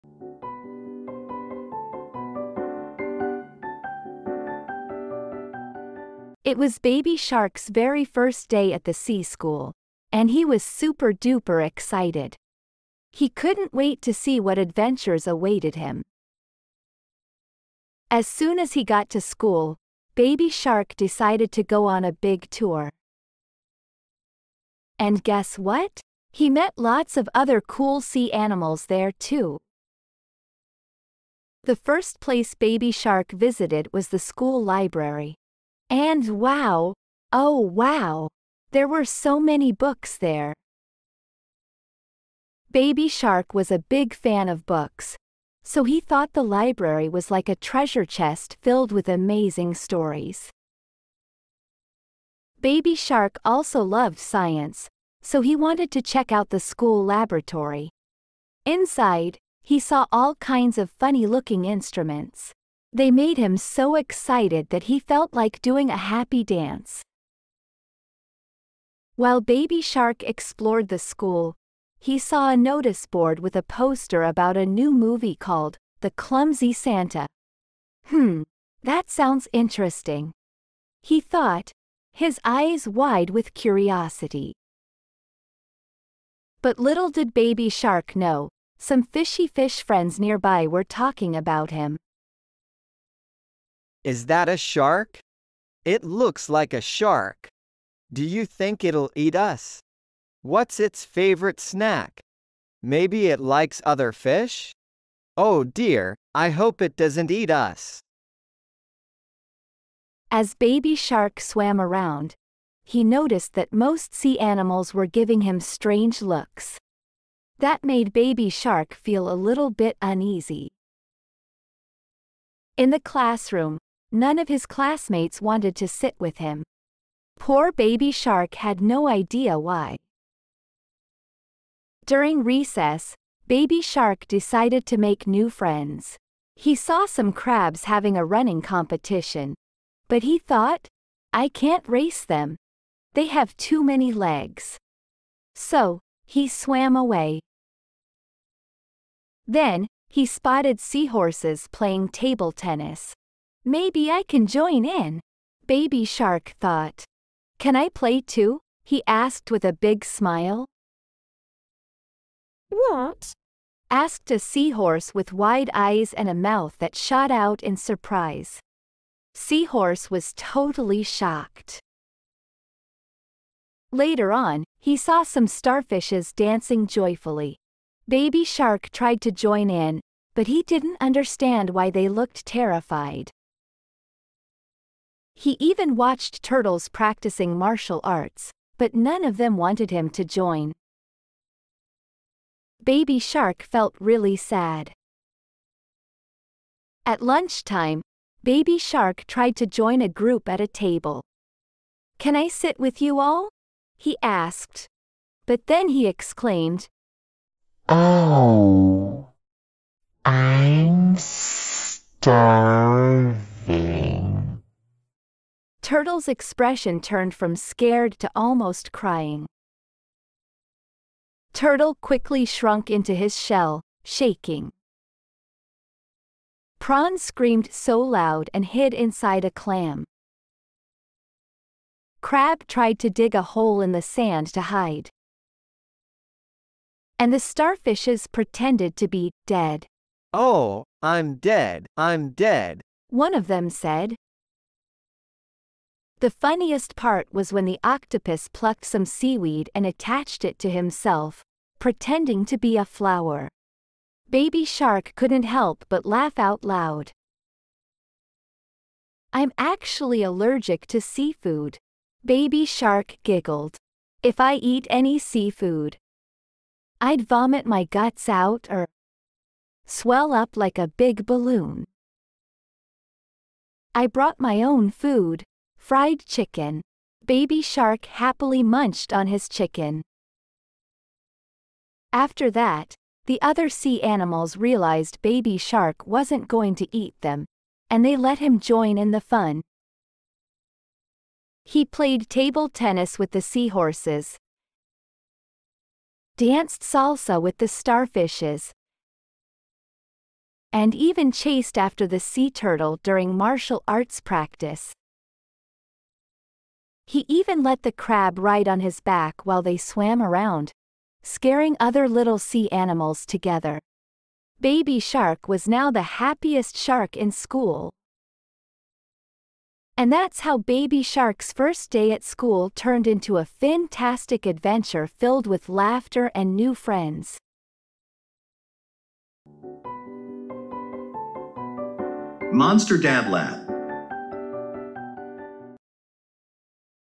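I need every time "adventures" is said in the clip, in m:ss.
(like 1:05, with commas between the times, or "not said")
0:14, 5:24.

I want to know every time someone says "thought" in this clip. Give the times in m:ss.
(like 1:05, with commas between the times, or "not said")
0:45, 1:21, 2:20, 2:36.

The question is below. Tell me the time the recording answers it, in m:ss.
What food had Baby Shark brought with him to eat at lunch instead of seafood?
4:35.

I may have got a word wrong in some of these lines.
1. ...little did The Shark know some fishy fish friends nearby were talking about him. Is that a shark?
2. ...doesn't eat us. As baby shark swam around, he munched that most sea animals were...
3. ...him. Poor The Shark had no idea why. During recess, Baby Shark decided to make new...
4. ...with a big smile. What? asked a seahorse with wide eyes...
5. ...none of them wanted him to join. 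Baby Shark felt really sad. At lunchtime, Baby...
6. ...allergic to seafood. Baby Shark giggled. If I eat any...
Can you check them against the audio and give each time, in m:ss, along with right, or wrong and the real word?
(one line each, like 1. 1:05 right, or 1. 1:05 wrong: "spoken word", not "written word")
1. 1:26 wrong: "Baby", not "The"
2. 1:46 wrong: "noticed", not "munched"
3. 2:06 wrong: "Baby", not "The"
4. 2:39 right
5. 3:08 right
6. 4:20 right.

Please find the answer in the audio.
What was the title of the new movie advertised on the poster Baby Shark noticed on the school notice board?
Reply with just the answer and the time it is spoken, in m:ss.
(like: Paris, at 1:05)
The Clumsy Santa, at 1:16.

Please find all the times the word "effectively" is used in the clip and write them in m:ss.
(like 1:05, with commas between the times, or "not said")
not said.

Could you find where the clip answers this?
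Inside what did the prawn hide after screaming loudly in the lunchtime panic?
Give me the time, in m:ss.
3:49.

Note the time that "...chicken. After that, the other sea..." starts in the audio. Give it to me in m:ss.
4:39.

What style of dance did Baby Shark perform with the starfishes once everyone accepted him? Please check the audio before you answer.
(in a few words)
Salsa.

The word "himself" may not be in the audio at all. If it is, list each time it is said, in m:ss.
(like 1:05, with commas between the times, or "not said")
4:10.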